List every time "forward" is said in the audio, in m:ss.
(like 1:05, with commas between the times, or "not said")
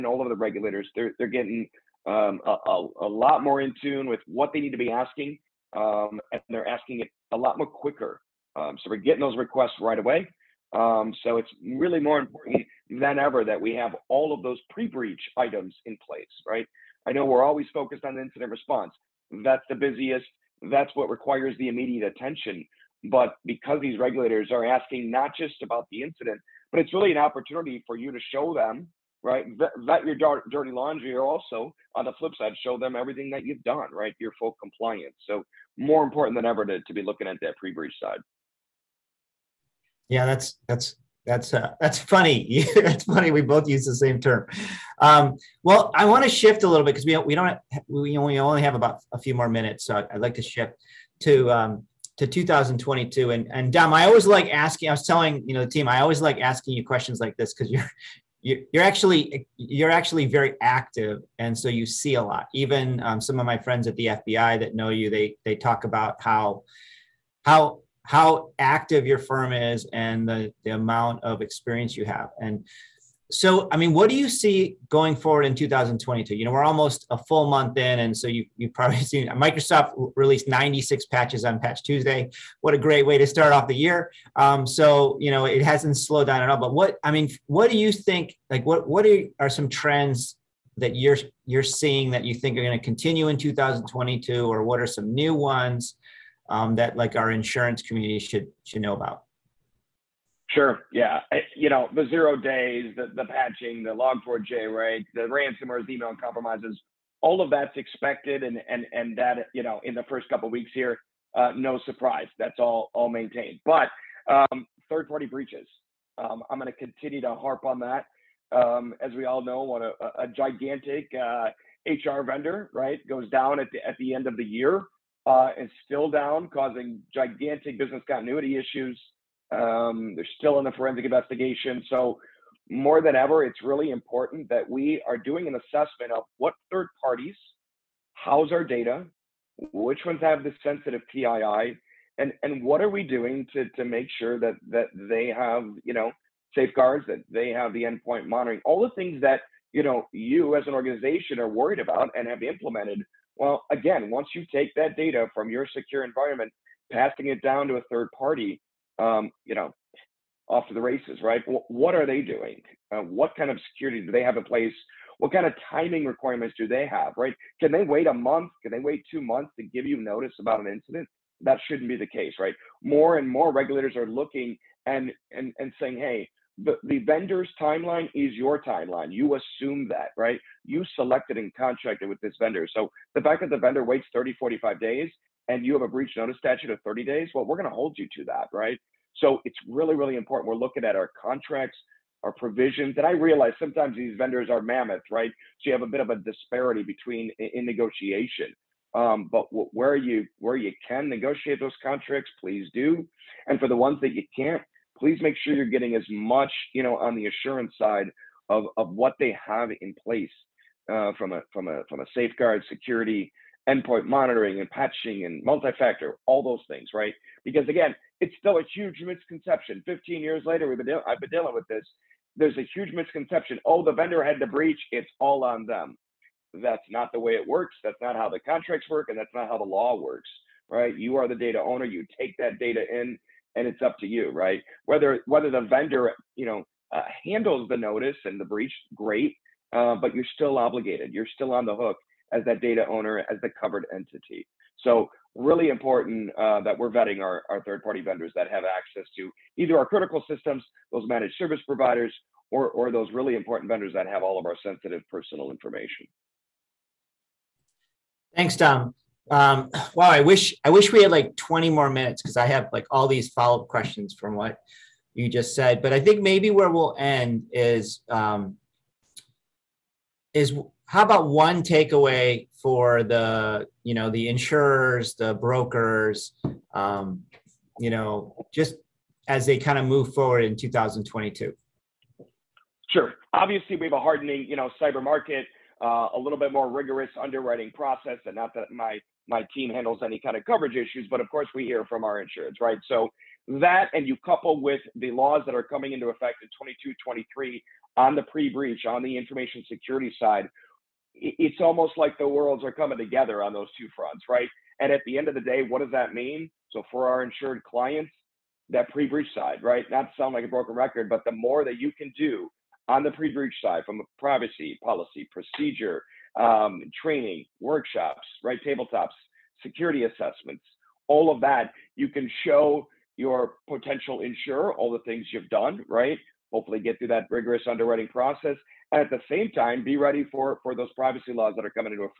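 1:15, 4:40.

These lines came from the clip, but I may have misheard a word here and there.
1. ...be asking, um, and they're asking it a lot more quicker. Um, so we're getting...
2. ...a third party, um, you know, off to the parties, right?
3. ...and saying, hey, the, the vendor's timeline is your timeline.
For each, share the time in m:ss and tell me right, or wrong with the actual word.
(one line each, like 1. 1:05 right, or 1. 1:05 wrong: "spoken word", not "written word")
1. 0:04 right
2. 2:37 wrong: "races", not "parties"
3. 2:55 right.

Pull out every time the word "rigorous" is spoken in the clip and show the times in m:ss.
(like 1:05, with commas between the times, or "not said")
4:46, 5:27.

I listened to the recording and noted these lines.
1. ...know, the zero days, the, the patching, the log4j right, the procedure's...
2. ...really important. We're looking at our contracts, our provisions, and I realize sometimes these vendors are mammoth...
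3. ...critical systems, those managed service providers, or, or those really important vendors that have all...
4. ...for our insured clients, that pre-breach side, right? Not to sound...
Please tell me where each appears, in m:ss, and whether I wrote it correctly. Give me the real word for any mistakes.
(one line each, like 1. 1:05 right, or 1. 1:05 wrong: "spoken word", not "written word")
1. 1:41 wrong: "ransomware", not "procedure"
2. 3:09 right
3. 4:09 right
4. 5:06 right.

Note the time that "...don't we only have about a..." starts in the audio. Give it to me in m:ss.
0:47.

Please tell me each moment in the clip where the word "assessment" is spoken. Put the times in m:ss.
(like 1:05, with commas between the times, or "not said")
2:15, 5:20.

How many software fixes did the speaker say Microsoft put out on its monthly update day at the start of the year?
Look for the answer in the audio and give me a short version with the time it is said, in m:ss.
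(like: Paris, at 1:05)
96, at 1:20.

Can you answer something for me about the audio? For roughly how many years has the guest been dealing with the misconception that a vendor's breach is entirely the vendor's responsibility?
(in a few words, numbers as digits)
15.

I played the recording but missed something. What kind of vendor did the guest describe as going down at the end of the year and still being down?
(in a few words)
HR vendor.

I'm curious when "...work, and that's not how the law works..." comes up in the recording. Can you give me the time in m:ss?
3:48.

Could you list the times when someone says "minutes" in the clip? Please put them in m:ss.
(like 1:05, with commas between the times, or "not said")
0:49, 4:21.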